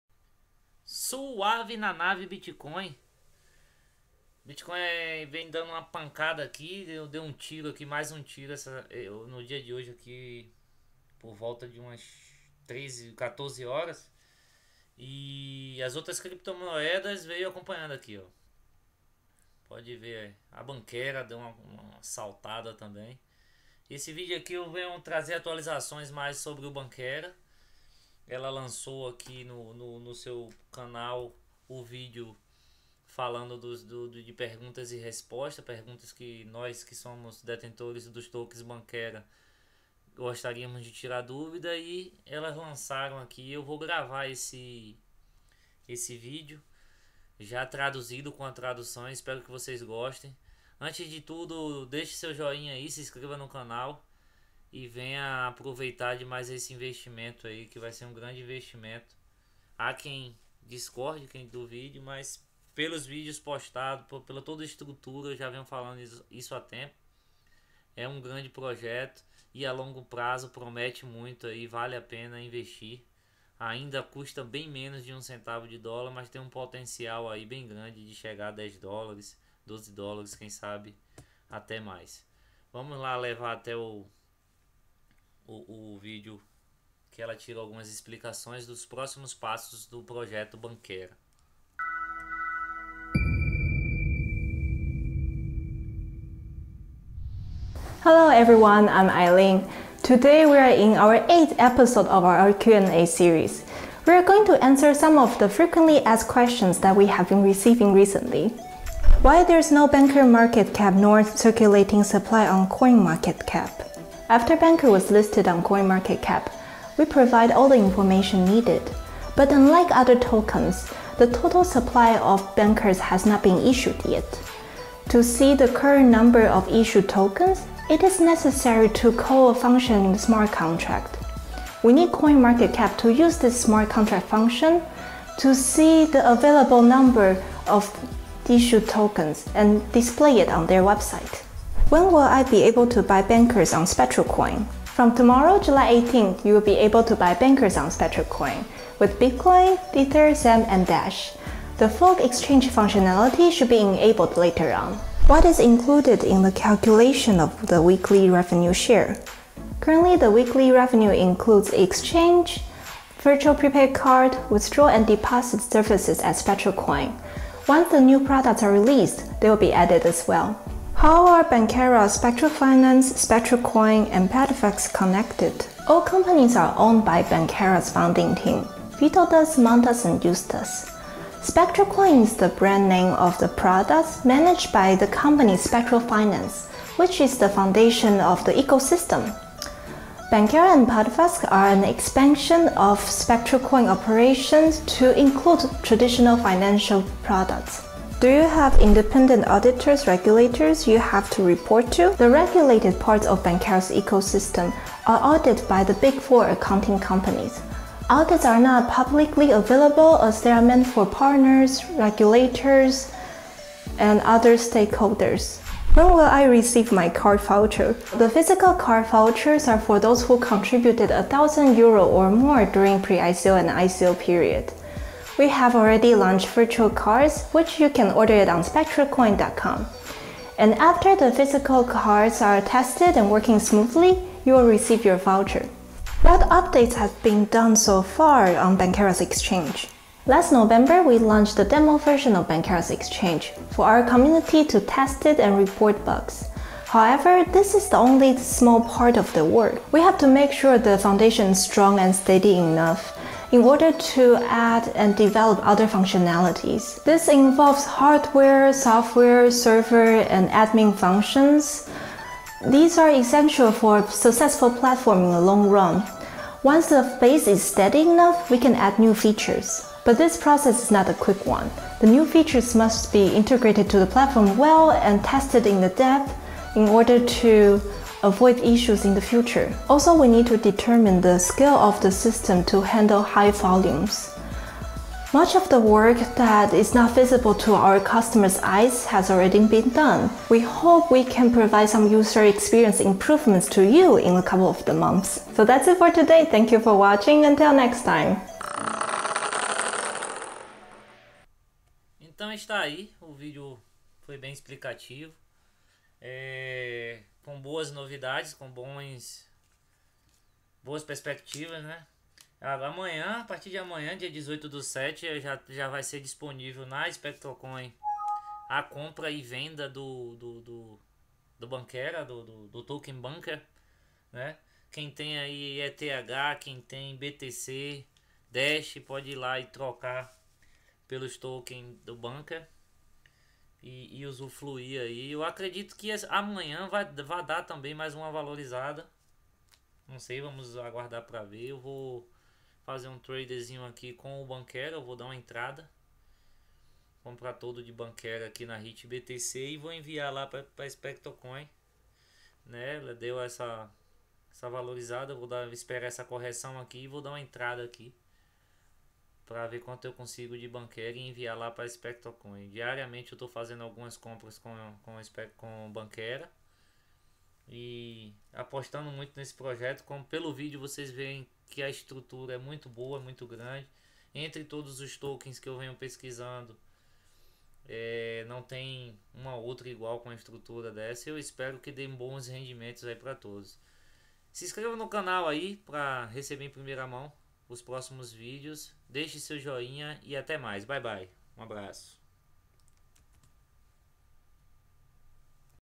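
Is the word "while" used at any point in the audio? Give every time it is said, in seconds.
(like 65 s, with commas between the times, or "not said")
not said.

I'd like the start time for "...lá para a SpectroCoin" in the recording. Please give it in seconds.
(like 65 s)
361 s.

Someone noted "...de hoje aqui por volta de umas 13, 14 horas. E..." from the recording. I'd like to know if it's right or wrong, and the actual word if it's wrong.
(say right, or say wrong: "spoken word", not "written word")
right.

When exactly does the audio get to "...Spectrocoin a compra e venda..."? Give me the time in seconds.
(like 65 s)
317 s.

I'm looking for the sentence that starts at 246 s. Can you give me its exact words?
However, this is the only small part of the work.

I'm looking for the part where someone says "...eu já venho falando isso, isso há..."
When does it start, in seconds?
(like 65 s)
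65 s.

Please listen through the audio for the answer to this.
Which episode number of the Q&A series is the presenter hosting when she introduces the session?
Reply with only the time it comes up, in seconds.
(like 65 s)
101 s.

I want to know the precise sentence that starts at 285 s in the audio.
Much of the work that is not visible to our customers' eyes has already been done.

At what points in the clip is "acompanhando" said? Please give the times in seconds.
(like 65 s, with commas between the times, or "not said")
17 s.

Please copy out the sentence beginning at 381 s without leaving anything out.
Eu espero que dê bons rendimentos aí para todos.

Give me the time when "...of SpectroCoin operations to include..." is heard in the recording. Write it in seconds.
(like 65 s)
192 s.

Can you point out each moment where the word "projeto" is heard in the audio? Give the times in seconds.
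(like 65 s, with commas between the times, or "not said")
68 s, 90 s, 369 s.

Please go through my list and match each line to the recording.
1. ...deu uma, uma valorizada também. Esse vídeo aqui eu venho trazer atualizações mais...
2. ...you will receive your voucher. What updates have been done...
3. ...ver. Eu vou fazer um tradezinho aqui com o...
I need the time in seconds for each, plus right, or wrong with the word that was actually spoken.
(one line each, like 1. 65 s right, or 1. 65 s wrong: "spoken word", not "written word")
1. 21 s wrong: "saltada", not "valorizada"
2. 234 s right
3. 341 s right.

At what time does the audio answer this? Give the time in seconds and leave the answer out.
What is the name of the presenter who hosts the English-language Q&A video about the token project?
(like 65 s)
99 s.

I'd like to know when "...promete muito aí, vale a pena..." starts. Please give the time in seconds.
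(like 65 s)
70 s.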